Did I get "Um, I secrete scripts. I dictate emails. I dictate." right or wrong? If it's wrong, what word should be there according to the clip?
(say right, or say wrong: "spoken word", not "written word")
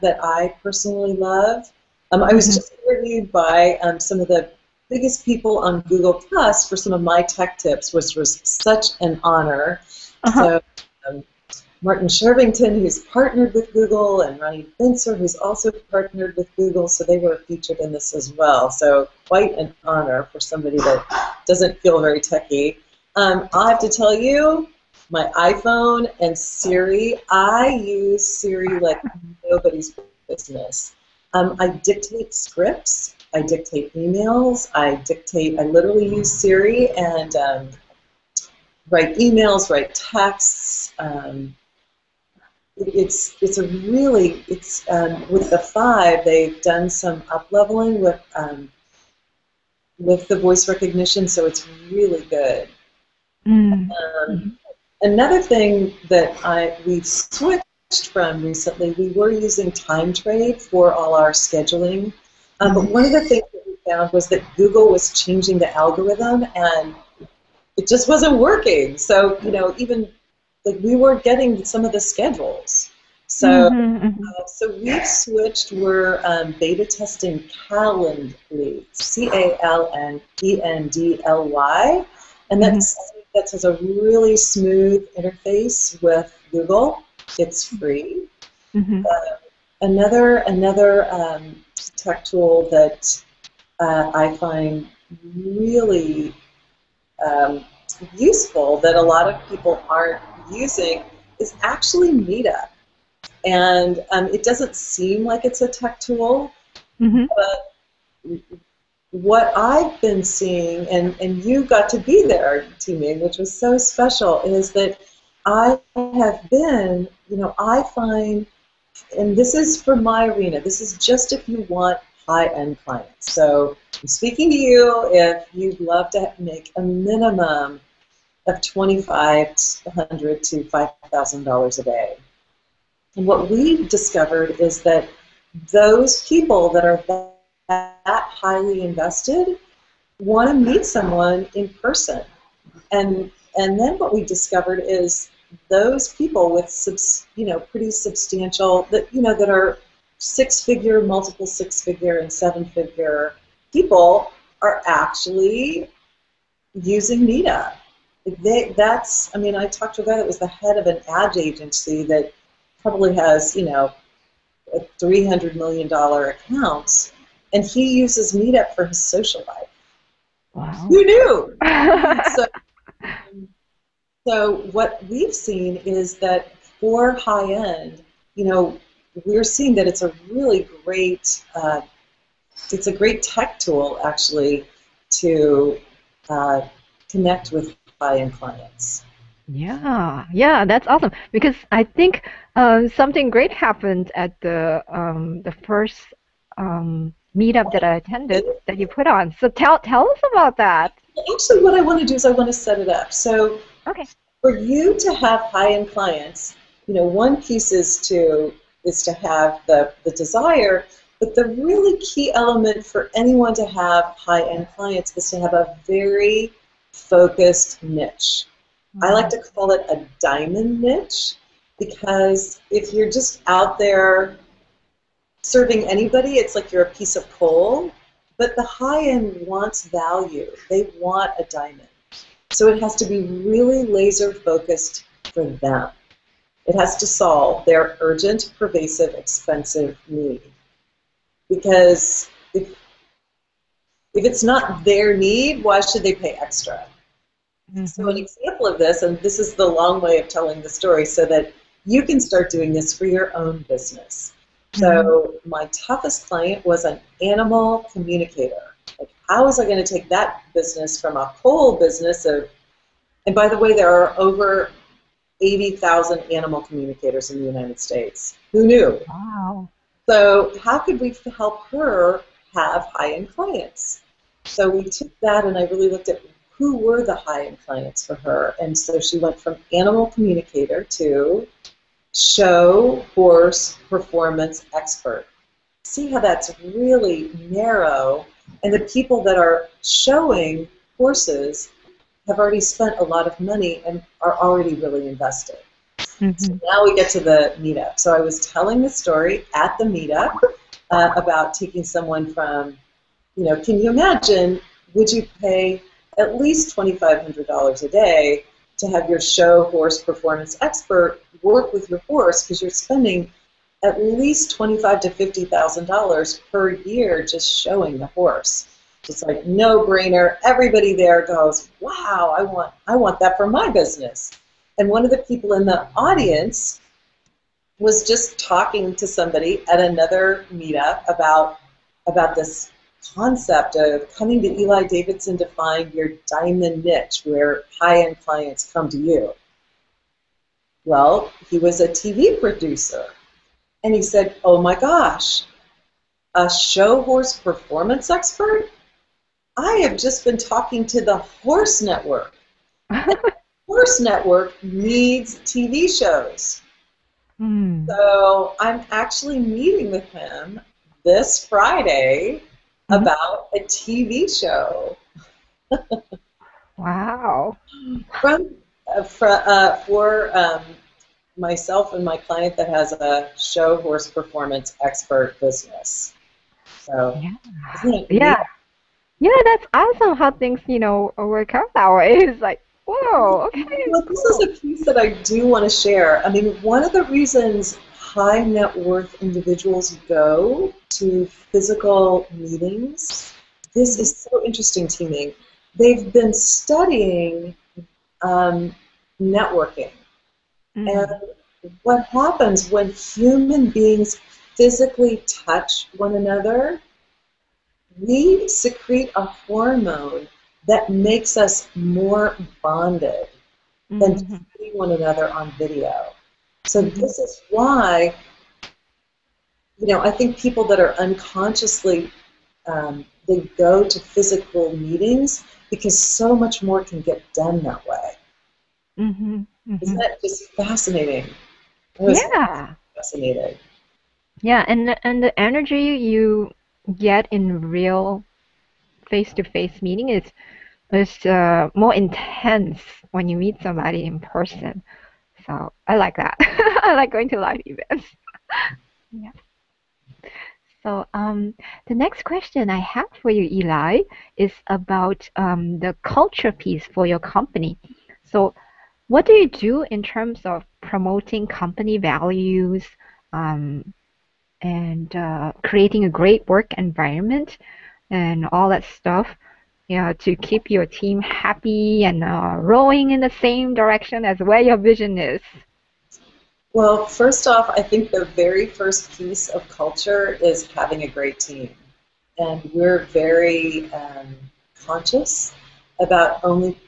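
wrong: "dictate", not "secrete".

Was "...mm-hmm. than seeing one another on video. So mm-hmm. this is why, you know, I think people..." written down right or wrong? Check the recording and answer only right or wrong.
right.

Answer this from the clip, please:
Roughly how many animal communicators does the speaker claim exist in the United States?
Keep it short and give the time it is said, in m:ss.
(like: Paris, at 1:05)
80,000, at 4:25.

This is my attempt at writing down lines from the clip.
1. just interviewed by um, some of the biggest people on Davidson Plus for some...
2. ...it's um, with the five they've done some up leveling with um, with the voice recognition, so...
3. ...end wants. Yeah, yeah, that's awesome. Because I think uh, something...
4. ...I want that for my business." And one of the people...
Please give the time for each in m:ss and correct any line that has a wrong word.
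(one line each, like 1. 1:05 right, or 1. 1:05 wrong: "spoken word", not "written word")
1. 0:02 wrong: "Google", not "Davidson"
2. 0:44 right
3. 3:08 wrong: "clients", not "wants"
4. 5:22 right.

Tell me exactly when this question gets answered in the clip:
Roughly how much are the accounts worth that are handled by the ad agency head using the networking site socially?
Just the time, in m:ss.
2:44.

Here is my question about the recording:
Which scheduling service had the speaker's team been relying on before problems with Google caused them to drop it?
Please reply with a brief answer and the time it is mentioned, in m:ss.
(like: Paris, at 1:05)
TimeTrade, at 0:59.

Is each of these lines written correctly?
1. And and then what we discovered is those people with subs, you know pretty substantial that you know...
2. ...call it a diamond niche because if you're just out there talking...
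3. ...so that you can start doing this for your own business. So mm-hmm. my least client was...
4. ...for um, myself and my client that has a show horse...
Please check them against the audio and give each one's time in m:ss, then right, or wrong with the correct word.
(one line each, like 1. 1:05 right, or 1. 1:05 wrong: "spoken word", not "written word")
1. 2:22 right
2. 3:39 wrong: "serving", not "talking"
3. 4:11 wrong: "toughest", not "least"
4. 6:09 right.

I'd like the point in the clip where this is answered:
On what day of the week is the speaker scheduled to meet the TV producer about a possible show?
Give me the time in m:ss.
6:01.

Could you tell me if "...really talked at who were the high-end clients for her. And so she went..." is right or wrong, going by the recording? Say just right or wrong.
wrong.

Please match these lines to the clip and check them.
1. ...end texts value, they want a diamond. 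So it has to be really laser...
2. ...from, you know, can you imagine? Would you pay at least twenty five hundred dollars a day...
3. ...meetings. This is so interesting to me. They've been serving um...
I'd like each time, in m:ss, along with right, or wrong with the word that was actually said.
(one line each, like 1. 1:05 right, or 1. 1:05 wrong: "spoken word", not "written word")
1. 3:49 wrong: "wants", not "texts"
2. 5:02 right
3. 6:32 wrong: "studying", not "serving".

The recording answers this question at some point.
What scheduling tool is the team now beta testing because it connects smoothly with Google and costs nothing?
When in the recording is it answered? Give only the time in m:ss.
1:17.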